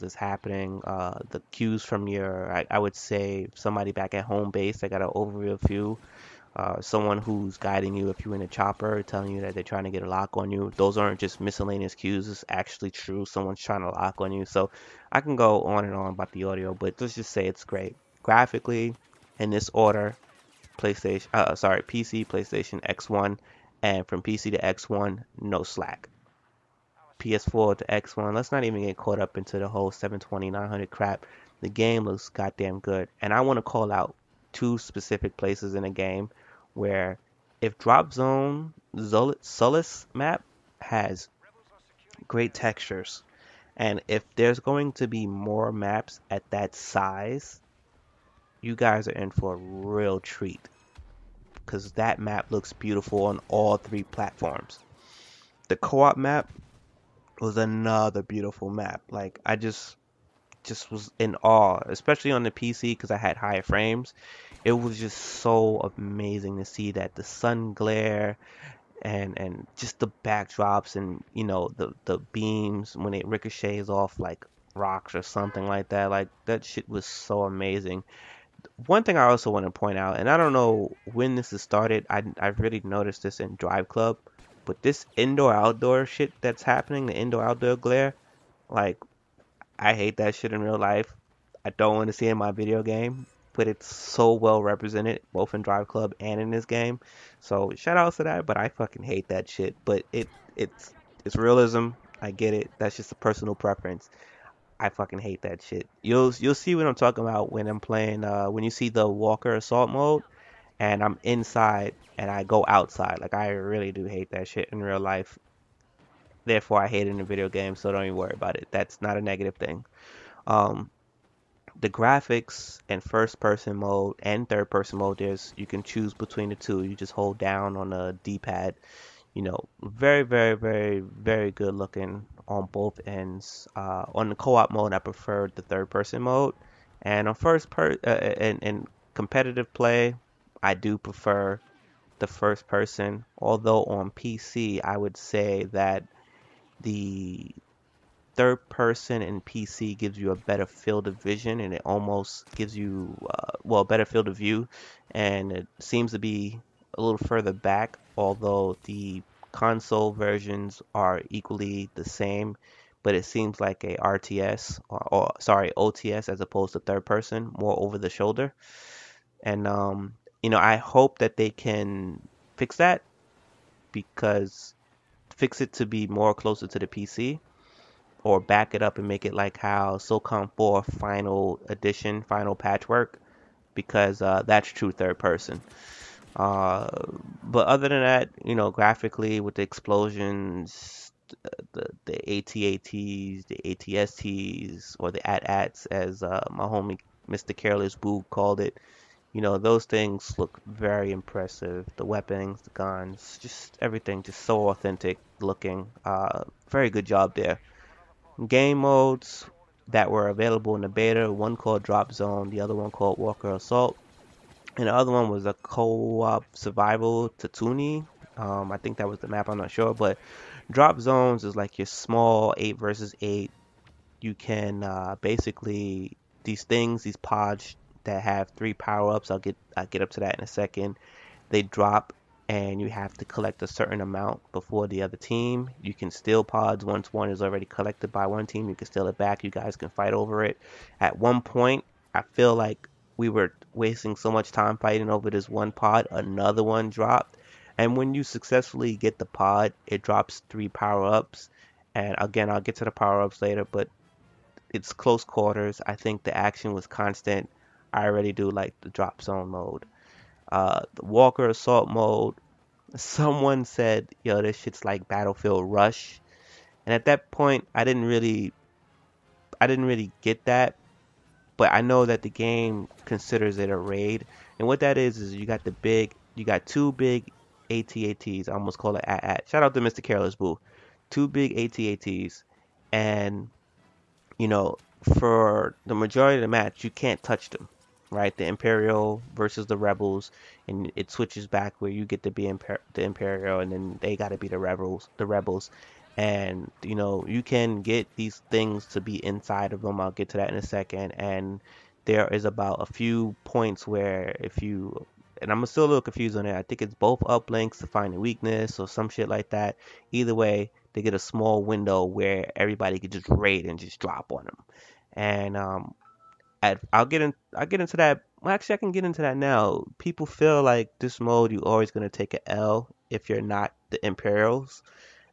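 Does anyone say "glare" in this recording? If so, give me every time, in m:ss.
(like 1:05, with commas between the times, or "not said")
1:07, 1:27.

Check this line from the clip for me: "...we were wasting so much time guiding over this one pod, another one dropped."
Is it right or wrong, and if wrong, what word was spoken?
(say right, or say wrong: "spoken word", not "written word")
wrong: "fighting", not "guiding".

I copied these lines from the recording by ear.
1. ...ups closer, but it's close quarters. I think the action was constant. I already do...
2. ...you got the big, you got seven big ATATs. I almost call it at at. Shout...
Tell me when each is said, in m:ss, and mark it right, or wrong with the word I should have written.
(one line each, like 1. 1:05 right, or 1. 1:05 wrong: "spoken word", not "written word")
1. 4:13 wrong: "later", not "closer"
2. 4:35 wrong: "two", not "seven".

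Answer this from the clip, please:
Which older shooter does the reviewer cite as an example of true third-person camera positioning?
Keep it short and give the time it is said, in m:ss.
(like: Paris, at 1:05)
SOCOM 4, at 2:59.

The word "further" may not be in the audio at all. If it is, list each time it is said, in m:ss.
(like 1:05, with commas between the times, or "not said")
2:37.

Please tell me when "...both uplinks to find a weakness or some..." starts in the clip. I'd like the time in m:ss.
5:06.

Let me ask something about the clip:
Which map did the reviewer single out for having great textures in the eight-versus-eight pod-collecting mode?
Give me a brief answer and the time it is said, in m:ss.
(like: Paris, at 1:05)
Sullust, at 0:39.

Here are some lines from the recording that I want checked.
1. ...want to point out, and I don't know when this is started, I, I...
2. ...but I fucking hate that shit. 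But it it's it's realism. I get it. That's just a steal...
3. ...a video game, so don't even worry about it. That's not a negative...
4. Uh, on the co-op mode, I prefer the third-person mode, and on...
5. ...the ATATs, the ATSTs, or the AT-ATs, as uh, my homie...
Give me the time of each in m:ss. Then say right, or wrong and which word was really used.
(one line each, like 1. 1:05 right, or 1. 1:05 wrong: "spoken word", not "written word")
1. 1:19 right
2. 1:38 wrong: "personal", not "steal"
3. 1:57 right
4. 2:13 right
5. 3:12 right.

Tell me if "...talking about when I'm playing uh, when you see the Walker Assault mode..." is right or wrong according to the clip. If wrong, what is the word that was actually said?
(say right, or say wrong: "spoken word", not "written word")
right.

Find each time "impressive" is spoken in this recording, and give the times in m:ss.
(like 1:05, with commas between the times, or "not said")
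3:21.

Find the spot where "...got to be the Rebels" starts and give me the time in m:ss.
4:54.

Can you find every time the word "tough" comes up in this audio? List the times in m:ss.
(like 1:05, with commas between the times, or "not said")
not said.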